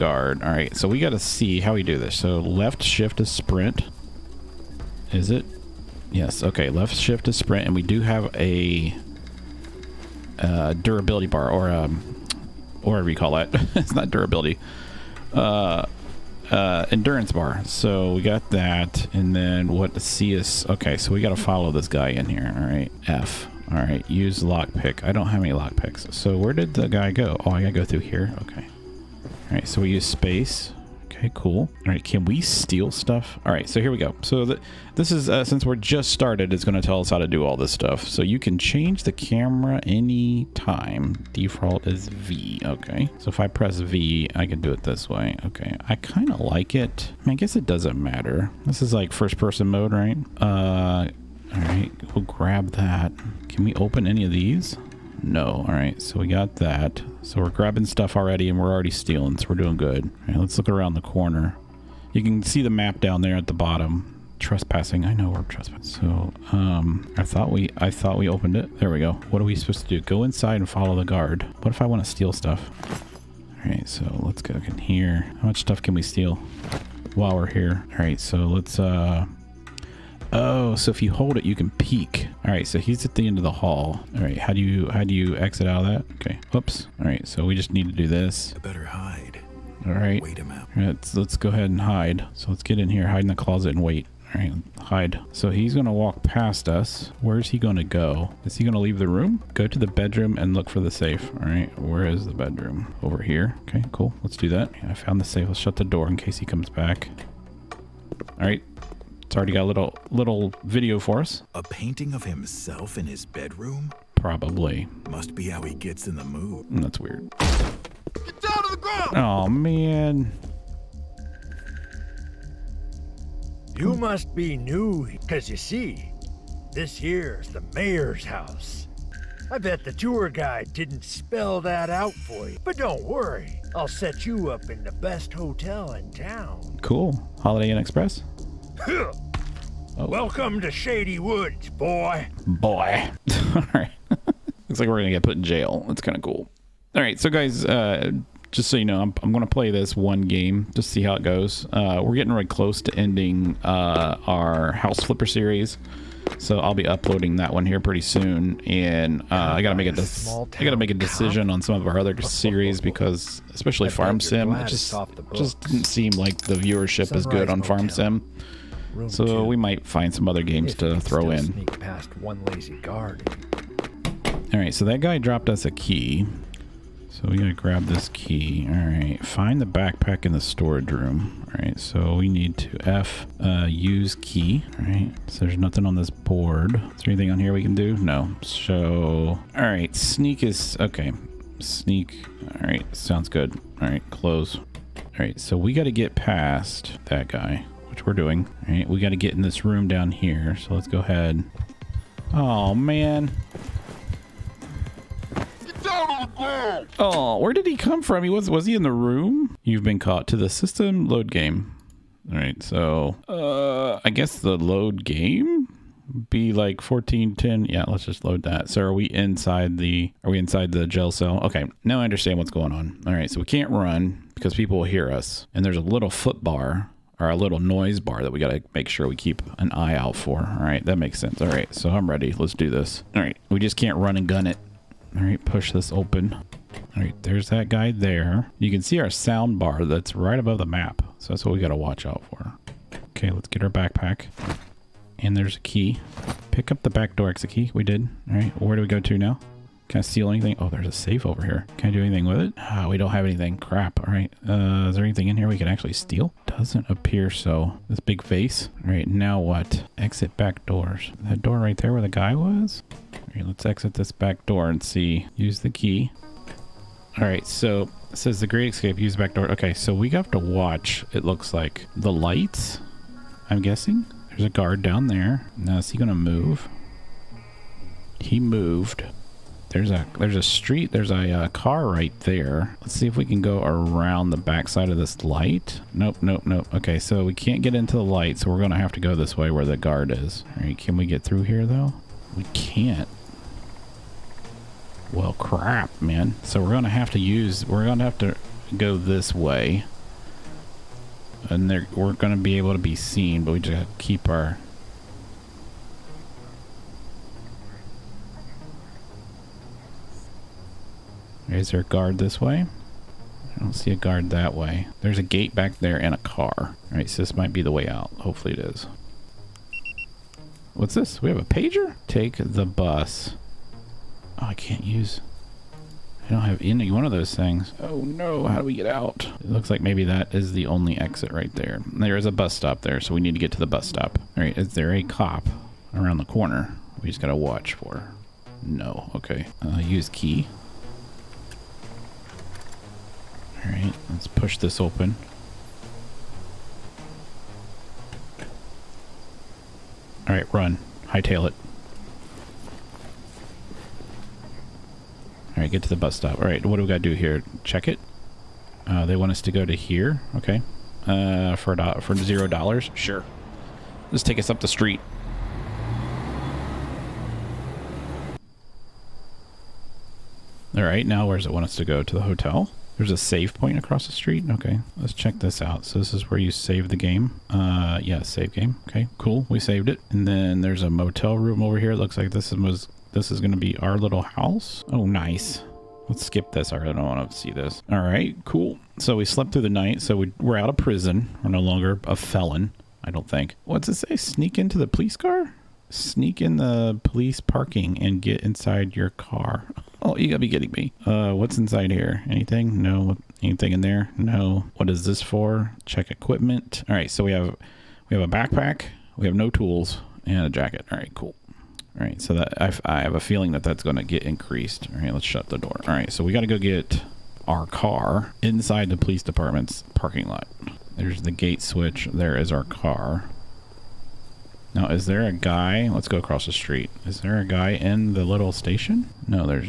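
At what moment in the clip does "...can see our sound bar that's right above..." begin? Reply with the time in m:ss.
3:58.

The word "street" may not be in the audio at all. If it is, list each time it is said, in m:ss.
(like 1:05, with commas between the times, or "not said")
4:40, 6:04, 6:14, 7:06.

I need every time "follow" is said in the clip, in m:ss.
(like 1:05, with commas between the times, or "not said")
0:21, 1:10.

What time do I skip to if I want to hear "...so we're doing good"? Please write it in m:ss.
0:59.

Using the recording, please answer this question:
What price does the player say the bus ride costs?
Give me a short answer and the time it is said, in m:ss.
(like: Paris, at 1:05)
$0, at 6:02.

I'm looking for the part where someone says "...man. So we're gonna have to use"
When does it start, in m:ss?
4:56.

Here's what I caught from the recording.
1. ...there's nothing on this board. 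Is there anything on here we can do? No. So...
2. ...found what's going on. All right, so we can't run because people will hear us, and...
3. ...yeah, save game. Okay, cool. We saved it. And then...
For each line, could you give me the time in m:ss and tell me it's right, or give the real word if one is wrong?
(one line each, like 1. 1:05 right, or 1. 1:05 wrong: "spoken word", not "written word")
1. 3:05 right
2. 3:42 wrong: "understand", not "found"
3. 6:18 right.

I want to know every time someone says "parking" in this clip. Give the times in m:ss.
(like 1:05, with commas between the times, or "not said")
6:37, 6:59.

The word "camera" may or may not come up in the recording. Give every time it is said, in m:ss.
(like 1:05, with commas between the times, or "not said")
0:39.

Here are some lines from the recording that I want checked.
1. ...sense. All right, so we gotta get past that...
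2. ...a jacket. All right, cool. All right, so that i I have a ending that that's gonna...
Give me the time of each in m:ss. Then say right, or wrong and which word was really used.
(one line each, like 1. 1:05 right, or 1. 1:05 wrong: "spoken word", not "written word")
1. 3:14 wrong: "close", not "sense"
2. 6:50 wrong: "feeling", not "ending".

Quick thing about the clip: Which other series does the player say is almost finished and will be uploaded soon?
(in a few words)
House Flipper.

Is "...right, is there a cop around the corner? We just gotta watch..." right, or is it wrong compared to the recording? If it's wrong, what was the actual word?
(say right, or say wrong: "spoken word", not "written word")
right.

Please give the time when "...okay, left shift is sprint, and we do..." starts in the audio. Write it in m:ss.
0:06.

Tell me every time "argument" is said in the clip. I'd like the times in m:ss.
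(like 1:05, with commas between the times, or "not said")
not said.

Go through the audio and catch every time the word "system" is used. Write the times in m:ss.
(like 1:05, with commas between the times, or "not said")
3:30.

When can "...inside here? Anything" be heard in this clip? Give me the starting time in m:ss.
6:41.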